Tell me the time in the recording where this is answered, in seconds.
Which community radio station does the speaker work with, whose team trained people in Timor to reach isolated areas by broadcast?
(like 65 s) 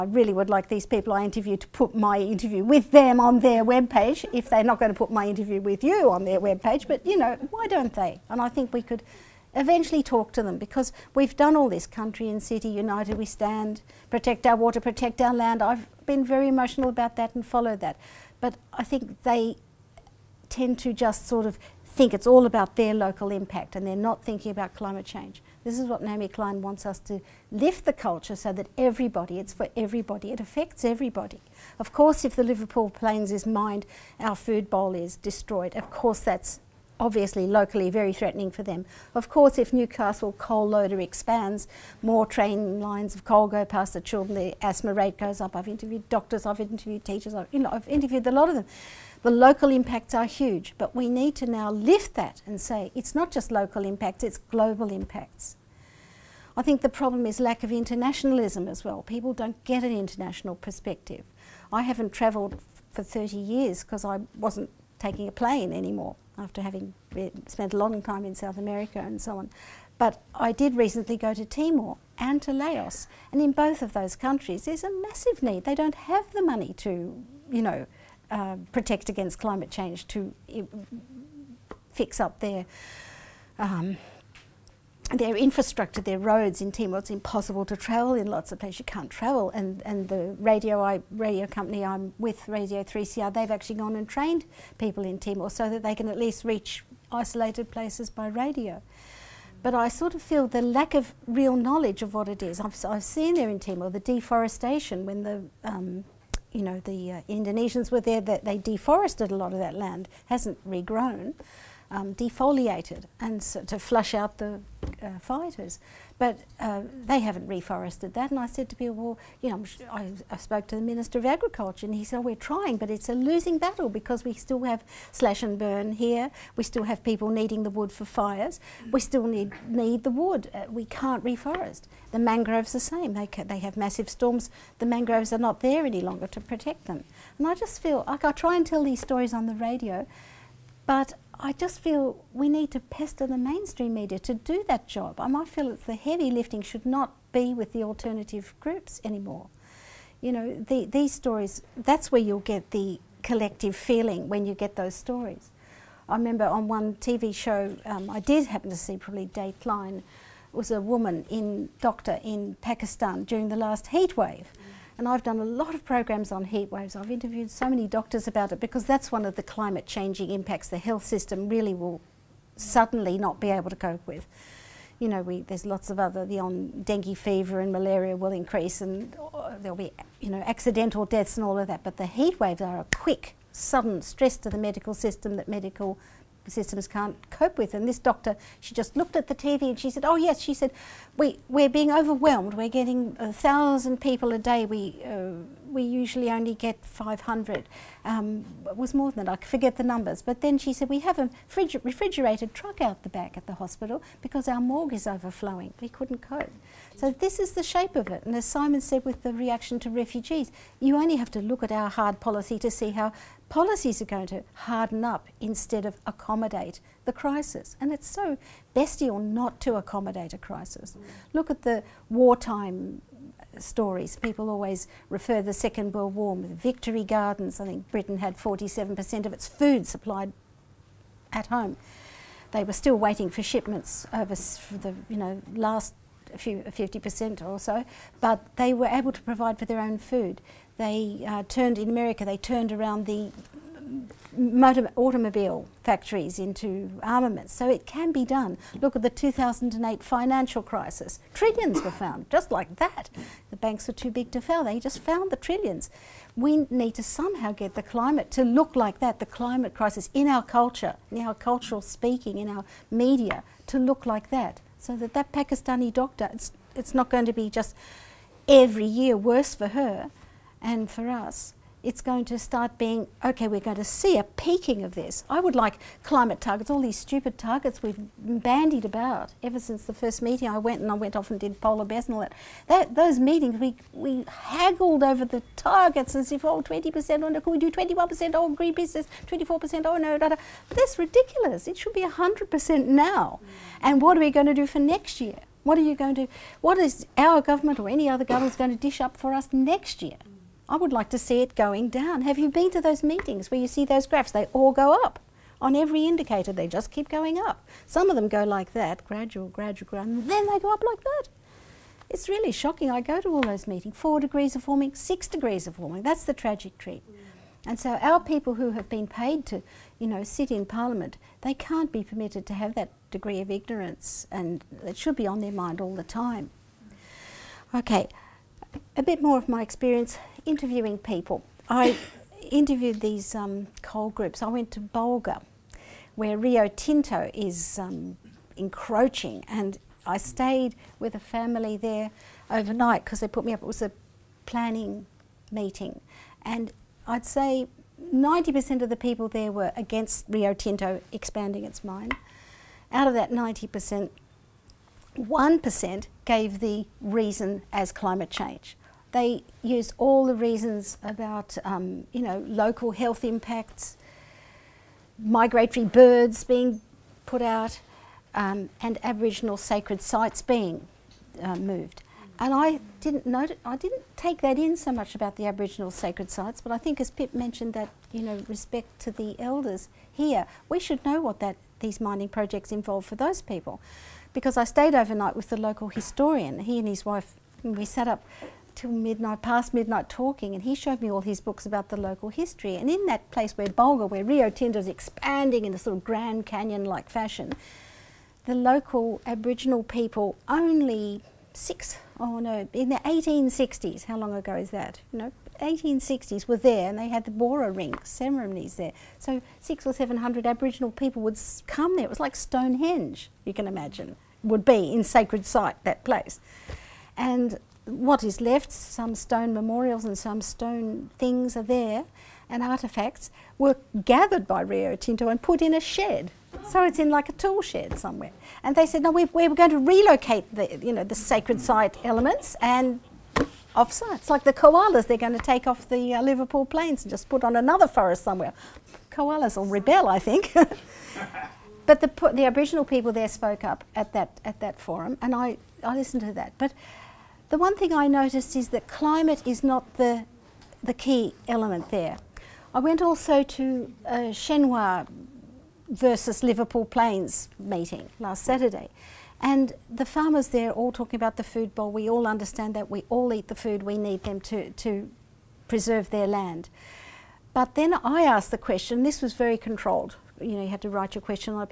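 92 s.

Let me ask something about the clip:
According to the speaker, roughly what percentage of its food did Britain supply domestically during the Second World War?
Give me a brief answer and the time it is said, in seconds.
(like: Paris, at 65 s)
47%, at 228 s.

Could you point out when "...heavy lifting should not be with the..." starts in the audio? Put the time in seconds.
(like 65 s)
145 s.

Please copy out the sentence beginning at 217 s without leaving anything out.
And it's so bestial not to accommodate a crisis.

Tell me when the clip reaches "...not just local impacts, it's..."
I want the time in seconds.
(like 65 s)
53 s.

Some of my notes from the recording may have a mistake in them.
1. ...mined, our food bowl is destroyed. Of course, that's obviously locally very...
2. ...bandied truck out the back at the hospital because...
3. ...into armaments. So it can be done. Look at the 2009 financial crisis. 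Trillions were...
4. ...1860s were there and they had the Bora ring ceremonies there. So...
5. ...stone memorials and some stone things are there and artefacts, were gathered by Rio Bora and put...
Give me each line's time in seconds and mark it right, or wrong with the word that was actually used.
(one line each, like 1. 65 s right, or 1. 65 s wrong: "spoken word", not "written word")
1. 33 s right
2. 201 s wrong: "refrigerated", not "bandied"
3. 246 s wrong: "2008", not "2009"
4. 405 s right
5. 419 s wrong: "Tinto", not "Bora".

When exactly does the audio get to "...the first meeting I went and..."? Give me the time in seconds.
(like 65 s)
279 s.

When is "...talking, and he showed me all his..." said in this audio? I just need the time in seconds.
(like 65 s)
390 s.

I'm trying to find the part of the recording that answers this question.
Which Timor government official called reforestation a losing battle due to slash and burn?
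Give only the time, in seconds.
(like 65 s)
120 s.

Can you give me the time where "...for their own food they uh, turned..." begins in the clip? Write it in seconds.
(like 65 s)
239 s.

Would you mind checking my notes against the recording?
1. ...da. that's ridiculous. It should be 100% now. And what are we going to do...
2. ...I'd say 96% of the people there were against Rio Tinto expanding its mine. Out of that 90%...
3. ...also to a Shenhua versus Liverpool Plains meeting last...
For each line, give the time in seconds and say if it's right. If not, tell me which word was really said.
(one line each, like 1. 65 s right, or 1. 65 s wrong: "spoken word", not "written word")
1. 290 s right
2. 347 s wrong: "90", not "96"
3. 453 s right.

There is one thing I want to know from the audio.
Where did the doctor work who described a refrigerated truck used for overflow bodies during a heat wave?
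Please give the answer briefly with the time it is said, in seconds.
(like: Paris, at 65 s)
Pakistan, at 162 s.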